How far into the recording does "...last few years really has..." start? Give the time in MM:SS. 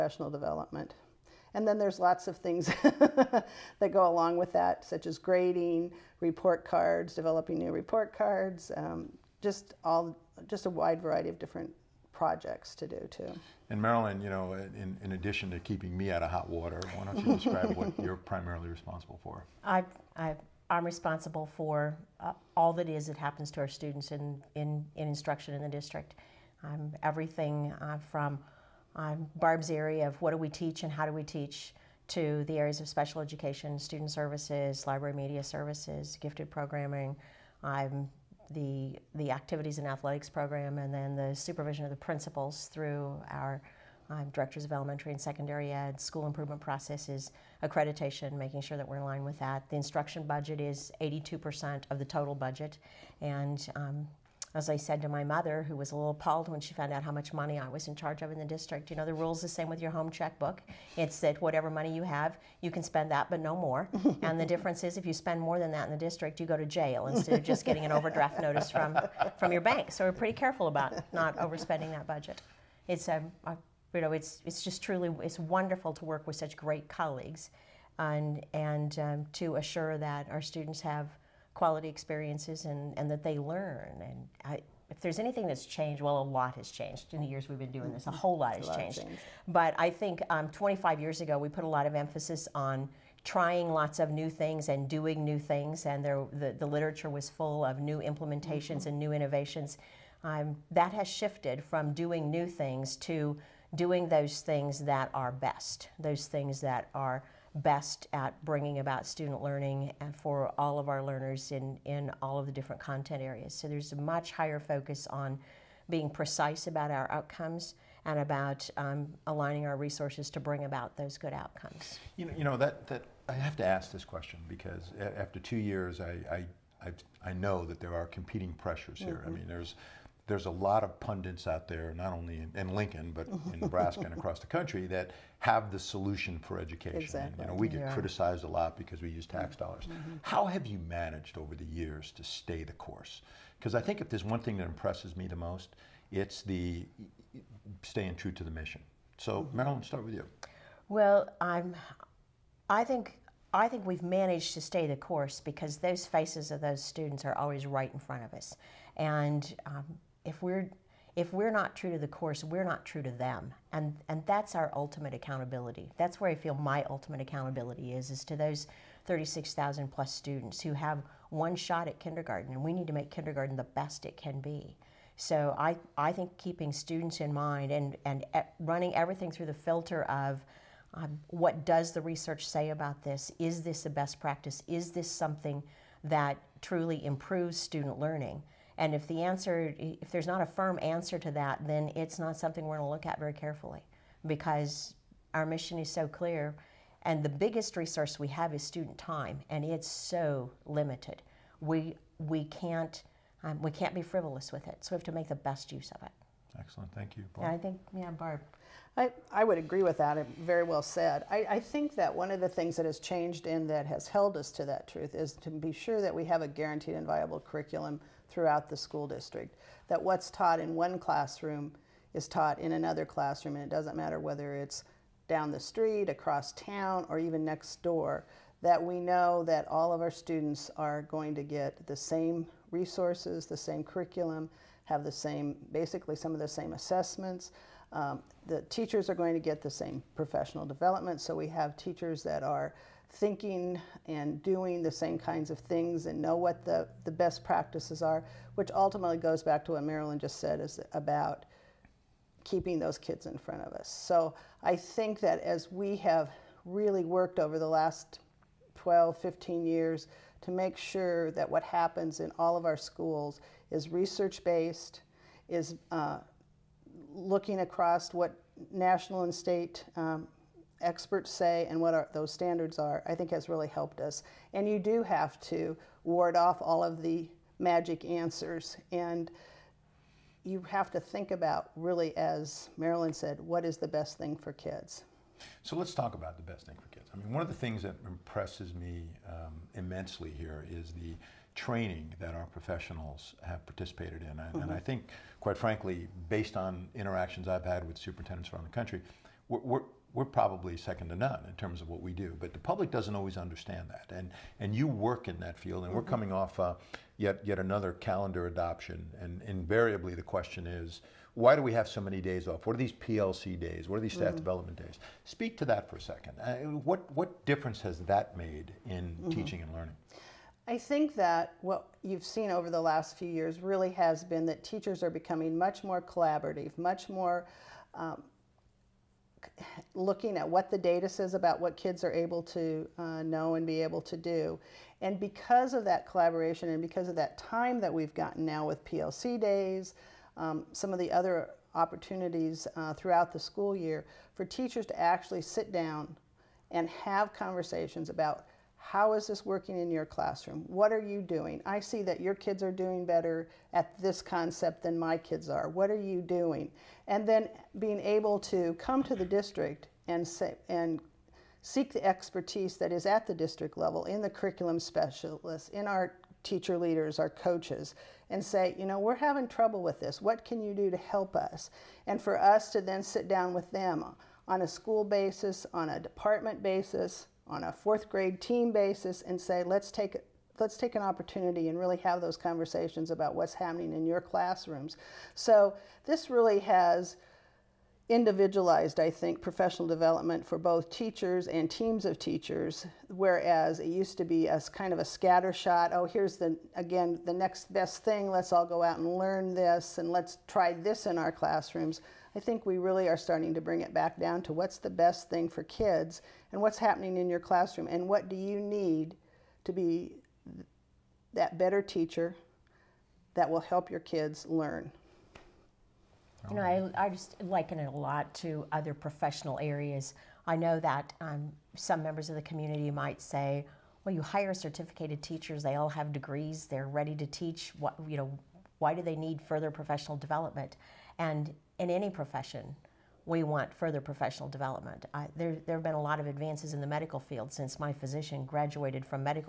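05:22.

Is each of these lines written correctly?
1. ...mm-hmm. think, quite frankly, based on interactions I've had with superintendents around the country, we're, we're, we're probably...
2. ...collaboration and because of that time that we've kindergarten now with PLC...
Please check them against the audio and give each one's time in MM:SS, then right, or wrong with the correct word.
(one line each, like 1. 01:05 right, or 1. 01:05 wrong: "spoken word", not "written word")
1. 04:54 right
2. 05:36 wrong: "gotten", not "kindergarten".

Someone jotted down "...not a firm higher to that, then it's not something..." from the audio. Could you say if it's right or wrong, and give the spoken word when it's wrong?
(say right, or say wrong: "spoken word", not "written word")
wrong: "answer", not "higher".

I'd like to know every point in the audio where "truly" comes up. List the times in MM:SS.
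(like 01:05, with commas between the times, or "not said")
01:14, 03:06.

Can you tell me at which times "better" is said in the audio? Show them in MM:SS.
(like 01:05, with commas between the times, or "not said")
05:53, 06:51.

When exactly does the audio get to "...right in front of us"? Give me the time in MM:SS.
02:37.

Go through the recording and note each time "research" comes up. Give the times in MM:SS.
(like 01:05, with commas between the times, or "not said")
03:02, 04:23.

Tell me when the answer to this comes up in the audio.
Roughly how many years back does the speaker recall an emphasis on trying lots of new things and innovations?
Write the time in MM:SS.
01:30.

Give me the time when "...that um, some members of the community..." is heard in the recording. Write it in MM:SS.
07:00.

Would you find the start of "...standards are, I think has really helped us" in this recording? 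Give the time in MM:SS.
04:32.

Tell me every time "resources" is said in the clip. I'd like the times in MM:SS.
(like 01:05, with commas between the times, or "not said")
01:59, 03:17, 03:52.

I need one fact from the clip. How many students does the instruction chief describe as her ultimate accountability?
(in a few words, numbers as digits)
36,000.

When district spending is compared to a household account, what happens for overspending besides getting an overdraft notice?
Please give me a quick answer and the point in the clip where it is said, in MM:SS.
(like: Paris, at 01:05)
go to jail, at 01:06.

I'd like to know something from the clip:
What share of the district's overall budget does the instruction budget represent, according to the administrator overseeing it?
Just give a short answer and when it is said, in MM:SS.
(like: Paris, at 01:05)
82%, at 00:50.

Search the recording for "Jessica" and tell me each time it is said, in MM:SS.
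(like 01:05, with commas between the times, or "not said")
not said.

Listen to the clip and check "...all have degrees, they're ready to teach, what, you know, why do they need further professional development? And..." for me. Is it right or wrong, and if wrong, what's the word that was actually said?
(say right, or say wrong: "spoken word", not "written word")
right.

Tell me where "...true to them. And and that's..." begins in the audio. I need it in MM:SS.
02:42.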